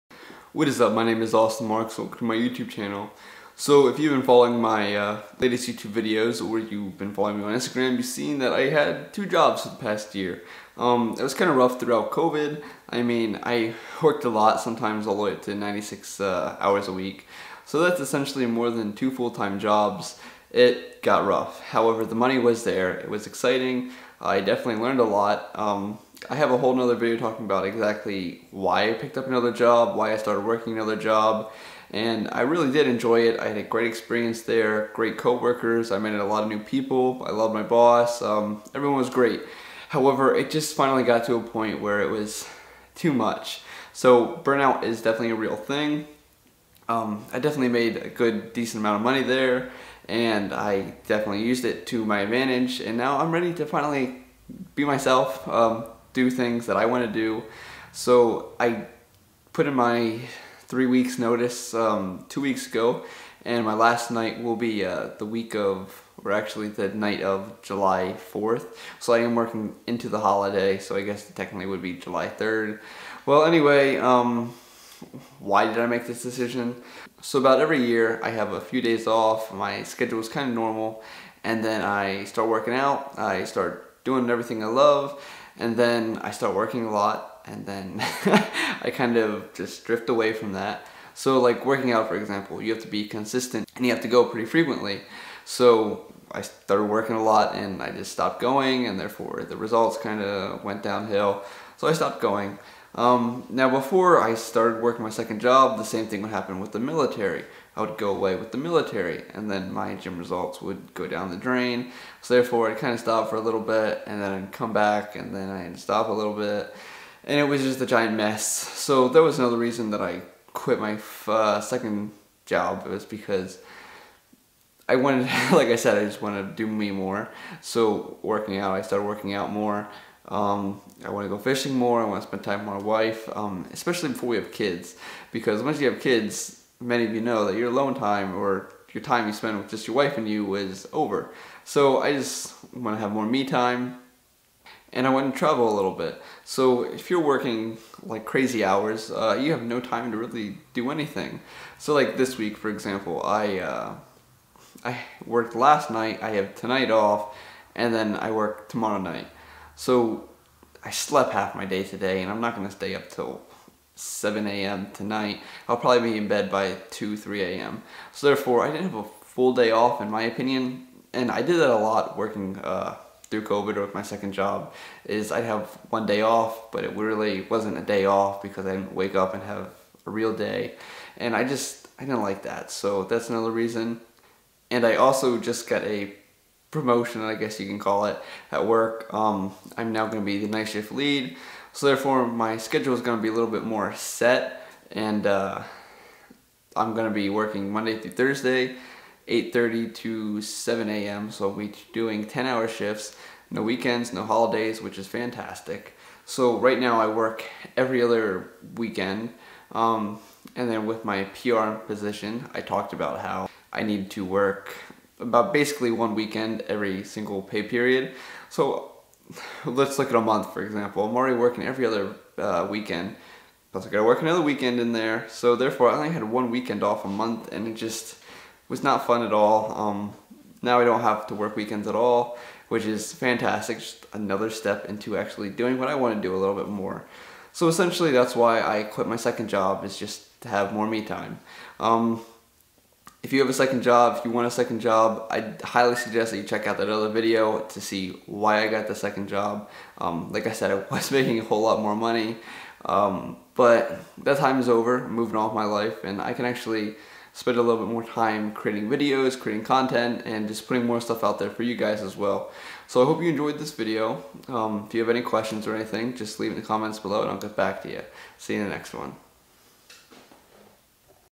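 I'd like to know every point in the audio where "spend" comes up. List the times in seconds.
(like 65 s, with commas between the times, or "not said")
132 s, 139 s, 257 s.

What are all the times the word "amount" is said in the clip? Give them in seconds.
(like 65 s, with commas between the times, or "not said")
48 s.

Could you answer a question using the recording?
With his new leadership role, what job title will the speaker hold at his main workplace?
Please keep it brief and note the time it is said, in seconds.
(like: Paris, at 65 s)
Night shift lead, at 190 s.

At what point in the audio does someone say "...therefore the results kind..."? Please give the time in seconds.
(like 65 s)
98 s.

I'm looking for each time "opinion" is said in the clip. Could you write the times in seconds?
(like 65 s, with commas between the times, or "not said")
170 s.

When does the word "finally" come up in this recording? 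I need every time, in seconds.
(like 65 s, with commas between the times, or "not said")
40 s, 53 s.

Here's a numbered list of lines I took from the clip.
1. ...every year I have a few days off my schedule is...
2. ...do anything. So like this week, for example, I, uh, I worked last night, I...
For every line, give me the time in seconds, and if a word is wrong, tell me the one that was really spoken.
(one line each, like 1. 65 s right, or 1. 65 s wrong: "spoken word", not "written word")
1. 77 s right
2. 150 s right.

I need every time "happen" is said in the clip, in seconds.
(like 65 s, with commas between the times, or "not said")
106 s.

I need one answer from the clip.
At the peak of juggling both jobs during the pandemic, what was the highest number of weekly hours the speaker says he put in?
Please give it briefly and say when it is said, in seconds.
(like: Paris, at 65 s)
96, at 15 s.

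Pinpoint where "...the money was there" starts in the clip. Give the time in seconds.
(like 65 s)
22 s.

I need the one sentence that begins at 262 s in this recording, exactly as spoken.
So I hope you enjoyed this video.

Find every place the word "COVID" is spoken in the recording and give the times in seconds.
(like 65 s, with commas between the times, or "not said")
12 s, 173 s.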